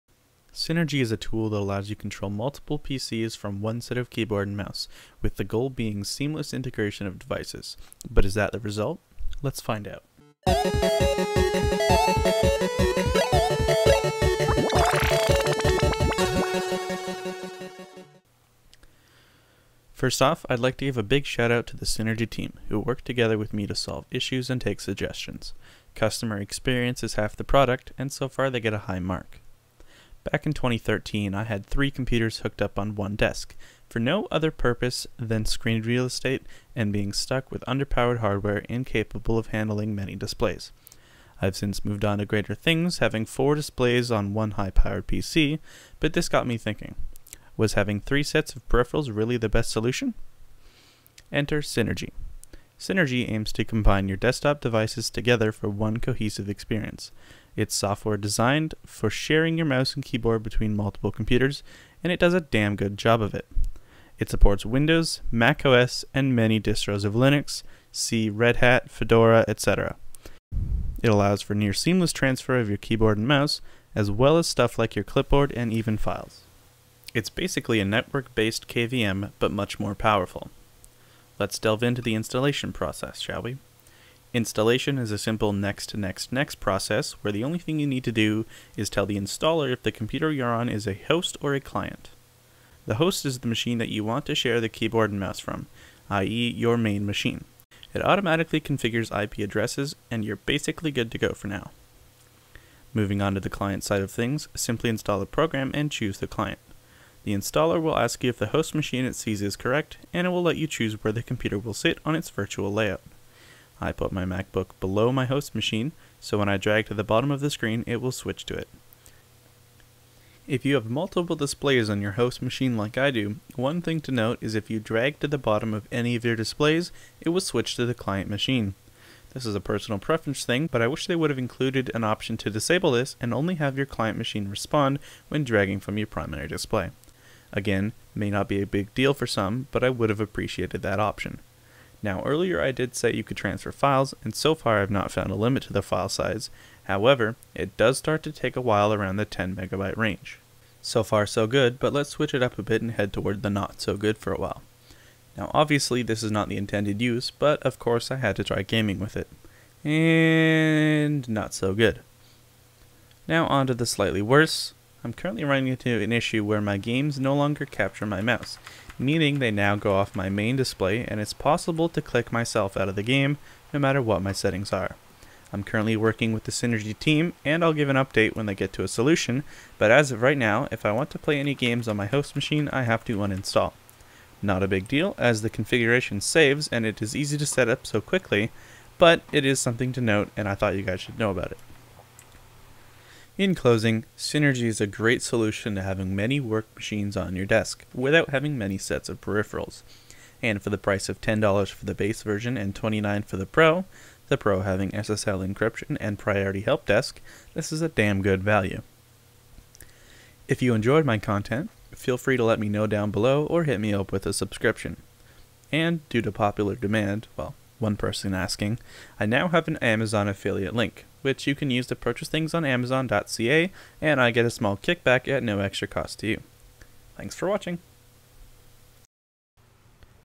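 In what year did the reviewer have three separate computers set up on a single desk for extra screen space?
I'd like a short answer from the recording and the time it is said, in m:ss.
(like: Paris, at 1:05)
2013, at 0:30.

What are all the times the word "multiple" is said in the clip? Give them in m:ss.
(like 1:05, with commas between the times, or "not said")
0:02, 1:00, 2:00.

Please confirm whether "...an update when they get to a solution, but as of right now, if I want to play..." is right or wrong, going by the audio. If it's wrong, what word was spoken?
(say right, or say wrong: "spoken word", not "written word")
right.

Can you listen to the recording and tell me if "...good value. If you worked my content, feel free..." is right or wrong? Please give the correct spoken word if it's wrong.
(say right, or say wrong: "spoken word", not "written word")
wrong: "enjoyed", not "worked".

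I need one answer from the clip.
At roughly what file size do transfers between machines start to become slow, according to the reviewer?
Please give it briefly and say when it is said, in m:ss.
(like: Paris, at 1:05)
10 megabytes, at 2:29.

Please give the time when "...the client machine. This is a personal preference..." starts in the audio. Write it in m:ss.
2:07.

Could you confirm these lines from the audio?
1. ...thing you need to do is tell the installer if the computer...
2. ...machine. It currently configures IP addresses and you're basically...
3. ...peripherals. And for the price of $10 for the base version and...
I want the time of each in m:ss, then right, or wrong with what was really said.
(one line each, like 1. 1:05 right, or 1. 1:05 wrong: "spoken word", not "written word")
1. 1:27 right
2. 1:37 wrong: "automatically", not "currently"
3. 3:19 right.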